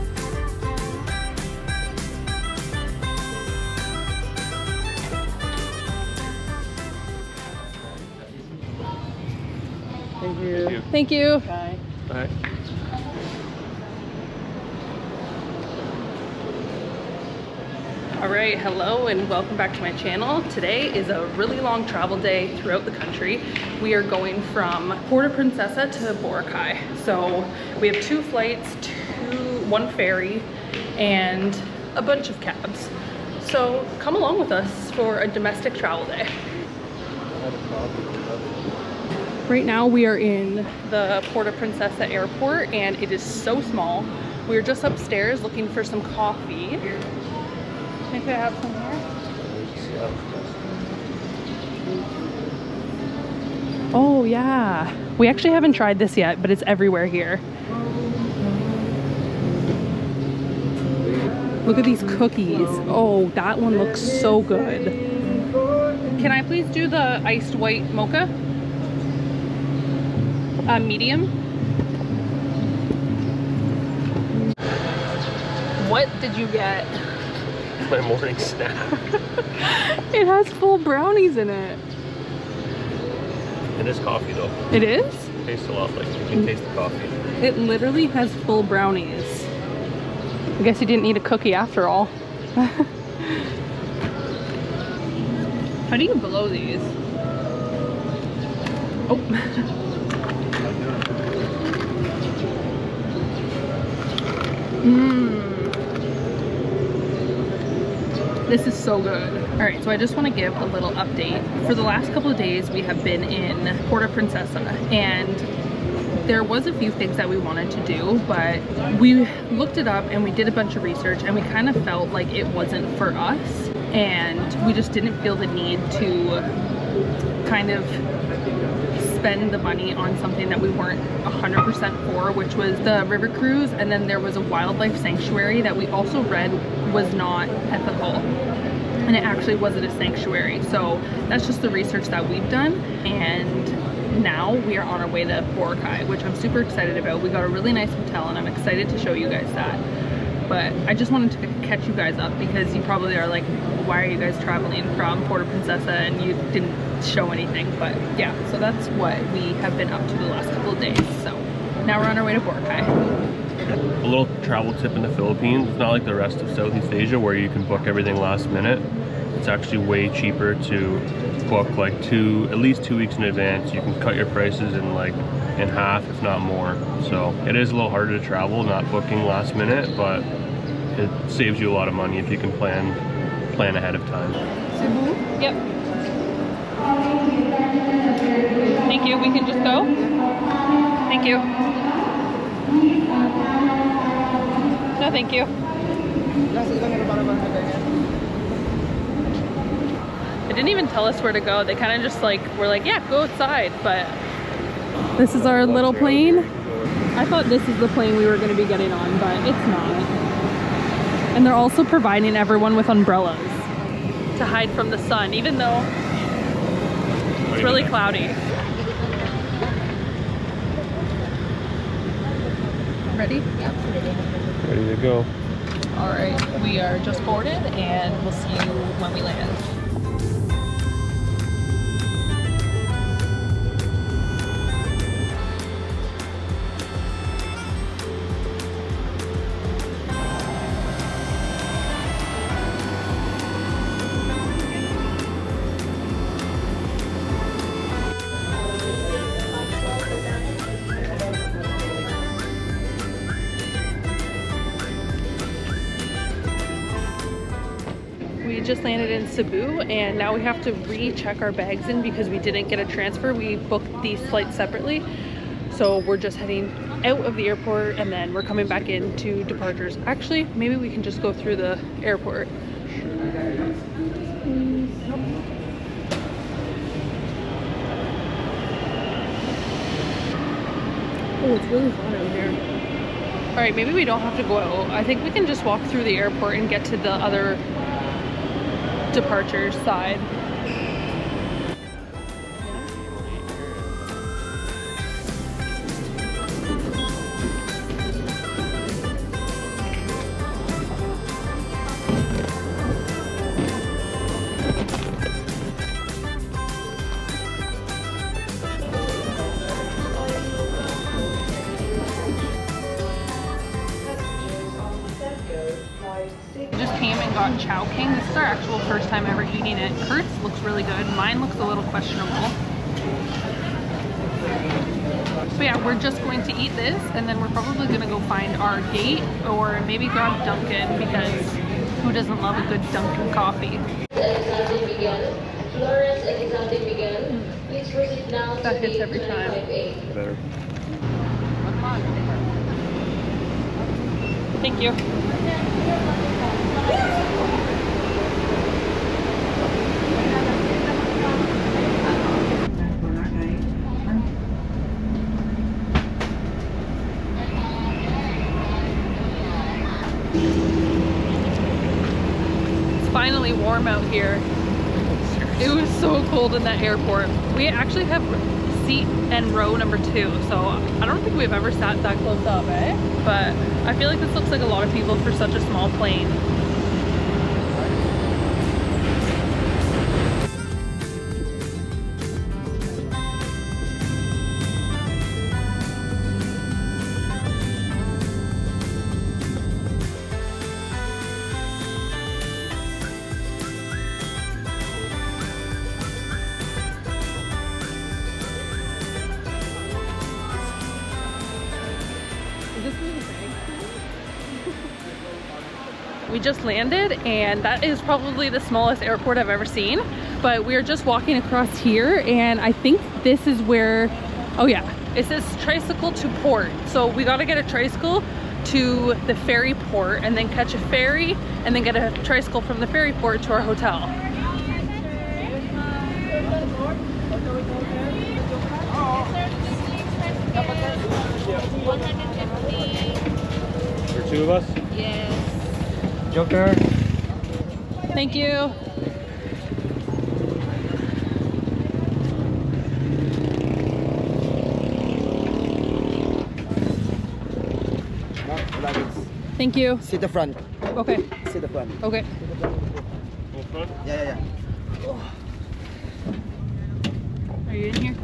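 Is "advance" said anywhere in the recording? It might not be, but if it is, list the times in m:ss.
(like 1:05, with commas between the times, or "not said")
2:53.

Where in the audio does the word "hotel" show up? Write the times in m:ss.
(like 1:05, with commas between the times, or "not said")
2:27, 7:03.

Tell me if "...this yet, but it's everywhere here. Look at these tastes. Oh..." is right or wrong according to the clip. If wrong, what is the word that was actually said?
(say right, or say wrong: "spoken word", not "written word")
wrong: "cookies", not "tastes".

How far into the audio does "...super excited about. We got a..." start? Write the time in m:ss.
2:26.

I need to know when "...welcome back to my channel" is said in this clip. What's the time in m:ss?
0:19.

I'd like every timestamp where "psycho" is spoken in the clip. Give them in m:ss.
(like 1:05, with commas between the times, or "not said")
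not said.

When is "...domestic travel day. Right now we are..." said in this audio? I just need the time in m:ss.
0:35.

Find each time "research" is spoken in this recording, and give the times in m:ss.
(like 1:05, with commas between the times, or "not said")
2:00, 2:21.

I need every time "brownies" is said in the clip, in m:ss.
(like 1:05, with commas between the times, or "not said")
1:20, 1:28.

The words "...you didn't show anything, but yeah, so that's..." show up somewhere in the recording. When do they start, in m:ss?
2:36.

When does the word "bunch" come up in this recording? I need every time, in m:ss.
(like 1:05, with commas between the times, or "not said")
0:32, 2:00.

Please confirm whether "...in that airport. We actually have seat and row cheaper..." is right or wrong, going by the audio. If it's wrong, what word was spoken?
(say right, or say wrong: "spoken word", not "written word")
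wrong: "number", not "cheaper".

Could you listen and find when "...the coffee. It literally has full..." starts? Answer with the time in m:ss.
1:26.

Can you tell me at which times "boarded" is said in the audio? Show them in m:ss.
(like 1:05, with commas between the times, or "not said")
3:47.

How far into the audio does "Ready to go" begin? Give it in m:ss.
3:44.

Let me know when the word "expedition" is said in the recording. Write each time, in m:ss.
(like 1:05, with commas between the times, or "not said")
not said.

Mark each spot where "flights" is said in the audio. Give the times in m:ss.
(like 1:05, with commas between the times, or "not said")
0:28, 4:24.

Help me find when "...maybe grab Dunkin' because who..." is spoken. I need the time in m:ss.
5:29.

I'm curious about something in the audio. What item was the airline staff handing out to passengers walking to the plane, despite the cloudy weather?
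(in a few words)
Umbrellas.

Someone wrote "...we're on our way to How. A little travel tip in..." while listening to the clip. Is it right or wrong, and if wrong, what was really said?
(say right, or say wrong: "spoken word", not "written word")
wrong: "Boracay", not "How".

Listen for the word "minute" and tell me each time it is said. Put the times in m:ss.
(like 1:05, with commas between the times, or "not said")
2:48, 2:59.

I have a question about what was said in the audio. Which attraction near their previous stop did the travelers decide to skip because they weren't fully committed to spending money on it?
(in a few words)
River cruise.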